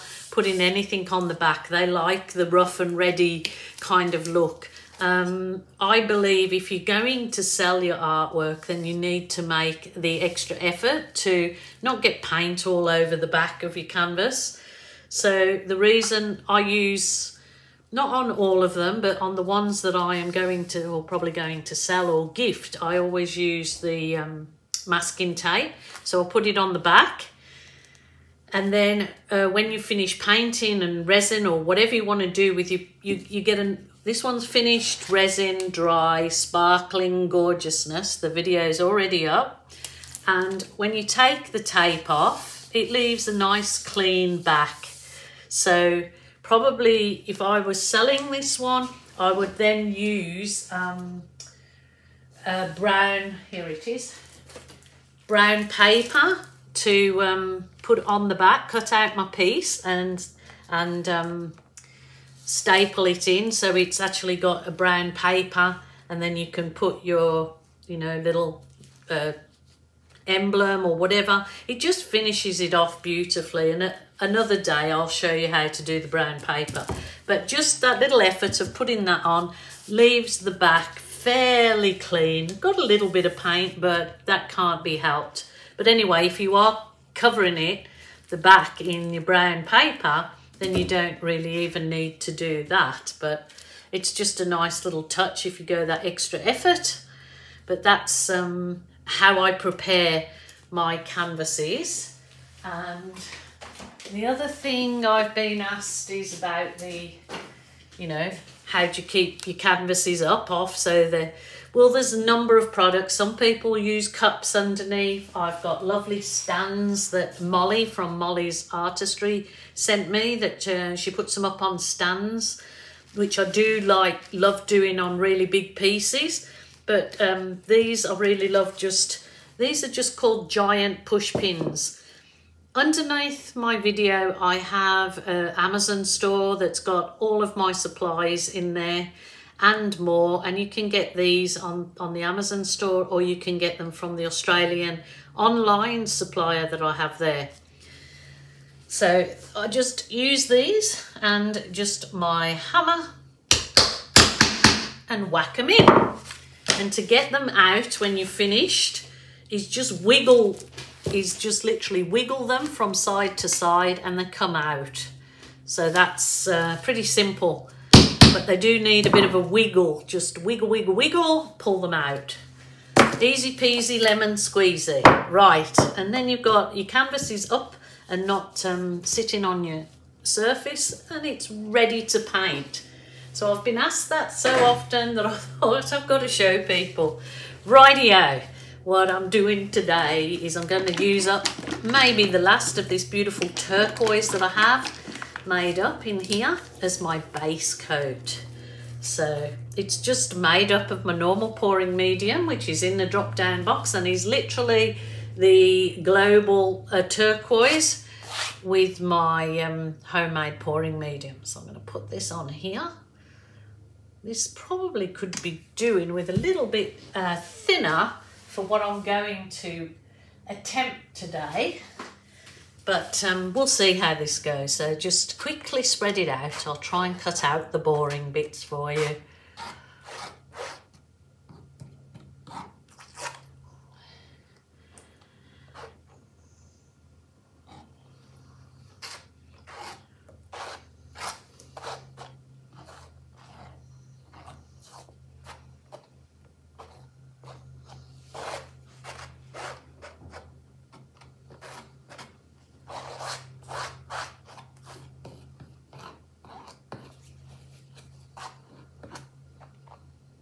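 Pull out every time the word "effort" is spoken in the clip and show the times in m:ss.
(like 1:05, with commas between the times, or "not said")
0:10, 1:18, 1:36.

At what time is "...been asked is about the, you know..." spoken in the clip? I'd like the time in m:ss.
1:45.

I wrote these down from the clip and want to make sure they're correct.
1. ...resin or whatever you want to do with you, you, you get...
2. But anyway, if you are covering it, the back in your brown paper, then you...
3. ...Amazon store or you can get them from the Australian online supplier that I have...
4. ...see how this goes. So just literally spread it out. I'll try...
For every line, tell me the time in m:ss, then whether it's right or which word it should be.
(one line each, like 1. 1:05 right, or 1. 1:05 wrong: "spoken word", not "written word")
1. 0:31 right
2. 1:25 right
3. 2:22 right
4. 3:43 wrong: "quickly", not "literally".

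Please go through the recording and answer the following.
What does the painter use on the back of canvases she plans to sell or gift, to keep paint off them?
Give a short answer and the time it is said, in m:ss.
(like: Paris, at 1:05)
masking tape, at 0:24.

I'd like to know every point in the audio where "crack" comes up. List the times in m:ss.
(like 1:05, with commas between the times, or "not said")
not said.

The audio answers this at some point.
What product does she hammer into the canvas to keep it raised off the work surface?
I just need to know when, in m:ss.
2:10.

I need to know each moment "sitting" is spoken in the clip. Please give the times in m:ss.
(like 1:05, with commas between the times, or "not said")
2:59.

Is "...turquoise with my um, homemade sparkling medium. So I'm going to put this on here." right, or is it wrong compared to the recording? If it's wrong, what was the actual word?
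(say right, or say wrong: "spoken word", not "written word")
wrong: "pouring", not "sparkling".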